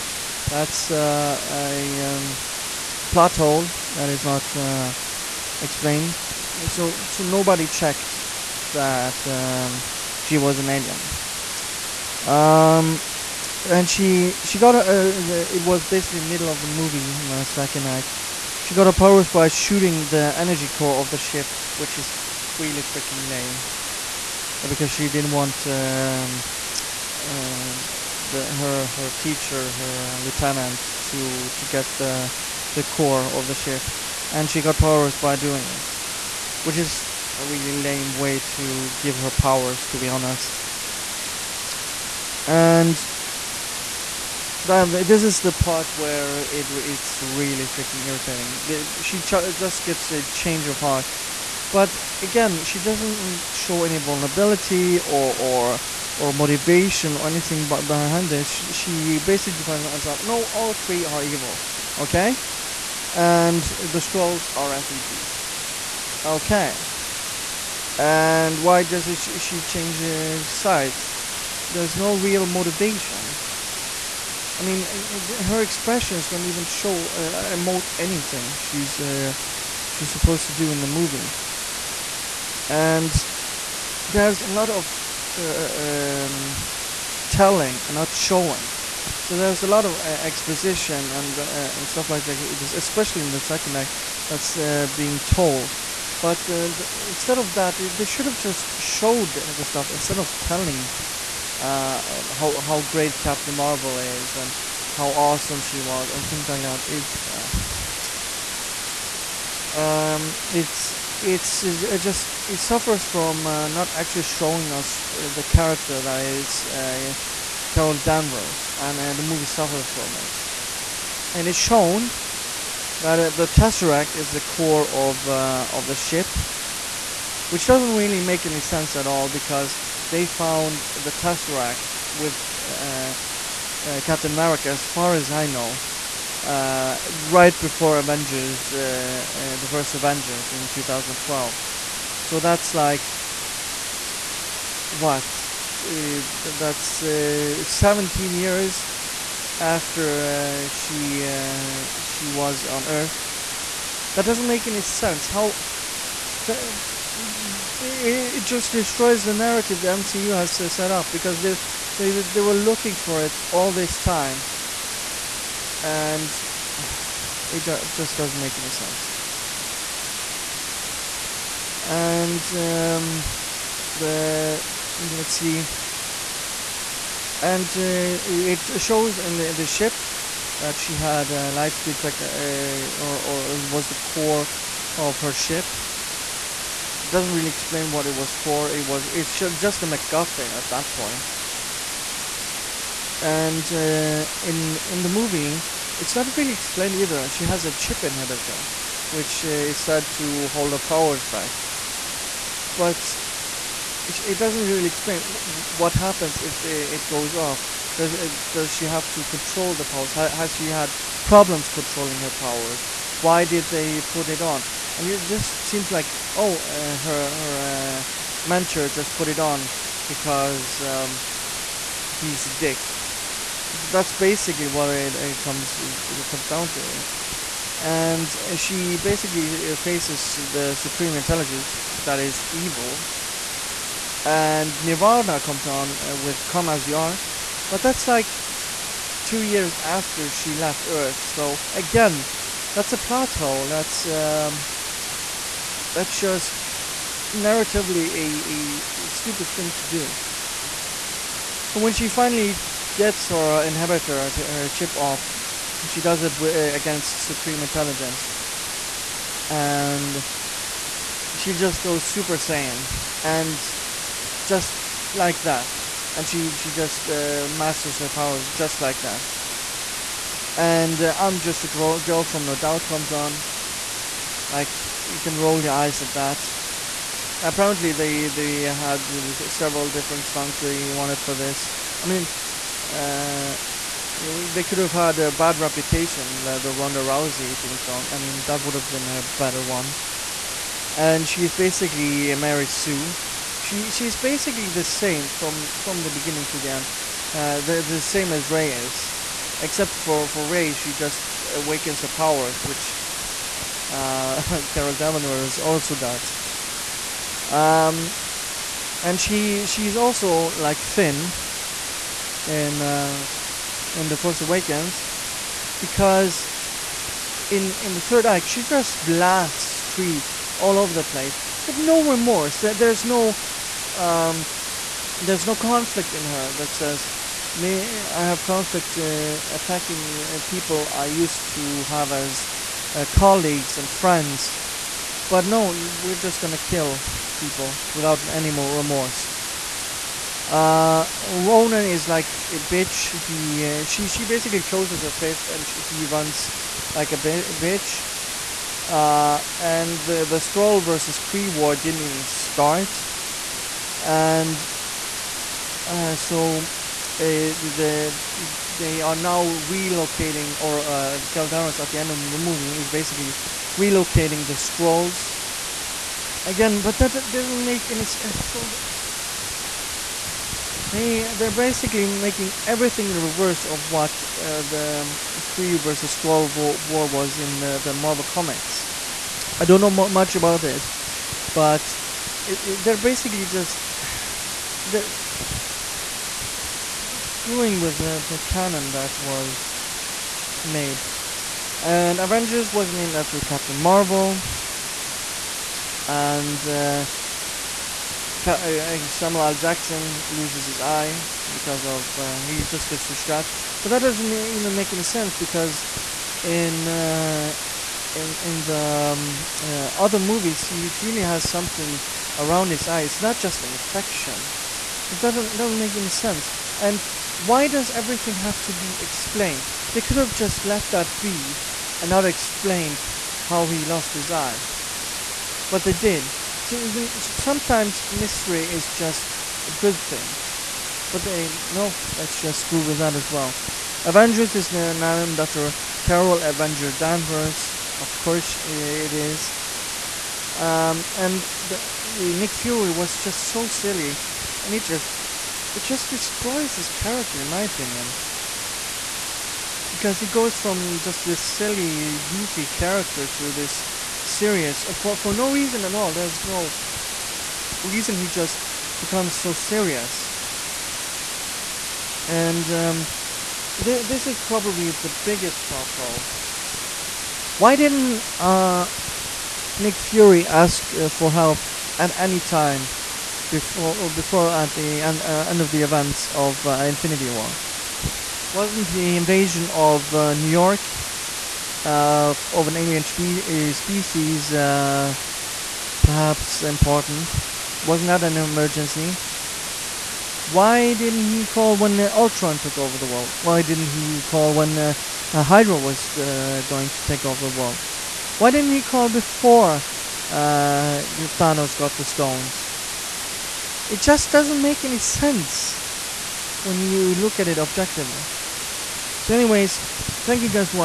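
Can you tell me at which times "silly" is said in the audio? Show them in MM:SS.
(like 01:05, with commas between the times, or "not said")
07:23, 07:31.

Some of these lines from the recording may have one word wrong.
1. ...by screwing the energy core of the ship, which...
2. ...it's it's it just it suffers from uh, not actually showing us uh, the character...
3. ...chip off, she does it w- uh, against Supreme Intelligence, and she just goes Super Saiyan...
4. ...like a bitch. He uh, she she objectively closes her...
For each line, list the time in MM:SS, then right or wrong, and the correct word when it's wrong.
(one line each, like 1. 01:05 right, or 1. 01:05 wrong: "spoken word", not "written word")
1. 00:19 wrong: "shooting", not "screwing"
2. 01:50 right
3. 04:14 right
4. 05:42 wrong: "basically", not "objectively".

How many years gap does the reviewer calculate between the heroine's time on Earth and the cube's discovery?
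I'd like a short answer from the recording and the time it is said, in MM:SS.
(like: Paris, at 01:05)
17, at 02:26.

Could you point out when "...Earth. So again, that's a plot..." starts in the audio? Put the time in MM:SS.
04:00.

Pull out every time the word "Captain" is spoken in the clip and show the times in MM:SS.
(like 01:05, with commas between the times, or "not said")
01:43, 02:14, 06:33.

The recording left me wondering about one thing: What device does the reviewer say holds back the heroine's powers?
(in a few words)
chip inhibitor.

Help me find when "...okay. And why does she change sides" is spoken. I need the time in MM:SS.
01:06.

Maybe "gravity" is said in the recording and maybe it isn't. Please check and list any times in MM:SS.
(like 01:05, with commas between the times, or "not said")
not said.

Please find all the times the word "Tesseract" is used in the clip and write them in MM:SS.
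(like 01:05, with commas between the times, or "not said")
02:03, 02:11.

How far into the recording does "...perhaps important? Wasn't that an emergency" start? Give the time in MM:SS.
08:06.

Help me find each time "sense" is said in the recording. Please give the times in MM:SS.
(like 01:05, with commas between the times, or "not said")
02:08, 02:34, 02:48, 06:08, 06:45, 06:56, 08:24.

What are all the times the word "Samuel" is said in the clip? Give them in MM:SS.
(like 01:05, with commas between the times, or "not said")
06:39.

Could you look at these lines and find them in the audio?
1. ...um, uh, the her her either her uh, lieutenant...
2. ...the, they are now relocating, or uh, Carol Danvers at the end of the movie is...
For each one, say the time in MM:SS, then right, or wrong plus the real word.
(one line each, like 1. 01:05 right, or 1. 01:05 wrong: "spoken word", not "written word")
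1. 00:25 wrong: "teacher", not "either"
2. 05:58 right.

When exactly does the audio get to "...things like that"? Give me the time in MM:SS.
01:46.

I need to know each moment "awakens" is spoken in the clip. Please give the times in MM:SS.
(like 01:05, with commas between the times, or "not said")
05:01, 05:14.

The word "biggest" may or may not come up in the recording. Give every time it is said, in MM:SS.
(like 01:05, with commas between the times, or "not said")
07:45.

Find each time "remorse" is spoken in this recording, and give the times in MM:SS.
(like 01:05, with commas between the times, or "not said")
05:22, 05:38.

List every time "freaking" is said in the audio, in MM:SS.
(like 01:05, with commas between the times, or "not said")
00:22, 00:47.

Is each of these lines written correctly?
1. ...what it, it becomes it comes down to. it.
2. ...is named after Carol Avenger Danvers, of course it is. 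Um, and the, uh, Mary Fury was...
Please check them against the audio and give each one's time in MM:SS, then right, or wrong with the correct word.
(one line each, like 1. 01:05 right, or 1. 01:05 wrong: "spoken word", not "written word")
1. 03:44 wrong: "comes", not "becomes"
2. 07:14 wrong: "Nick", not "Mary".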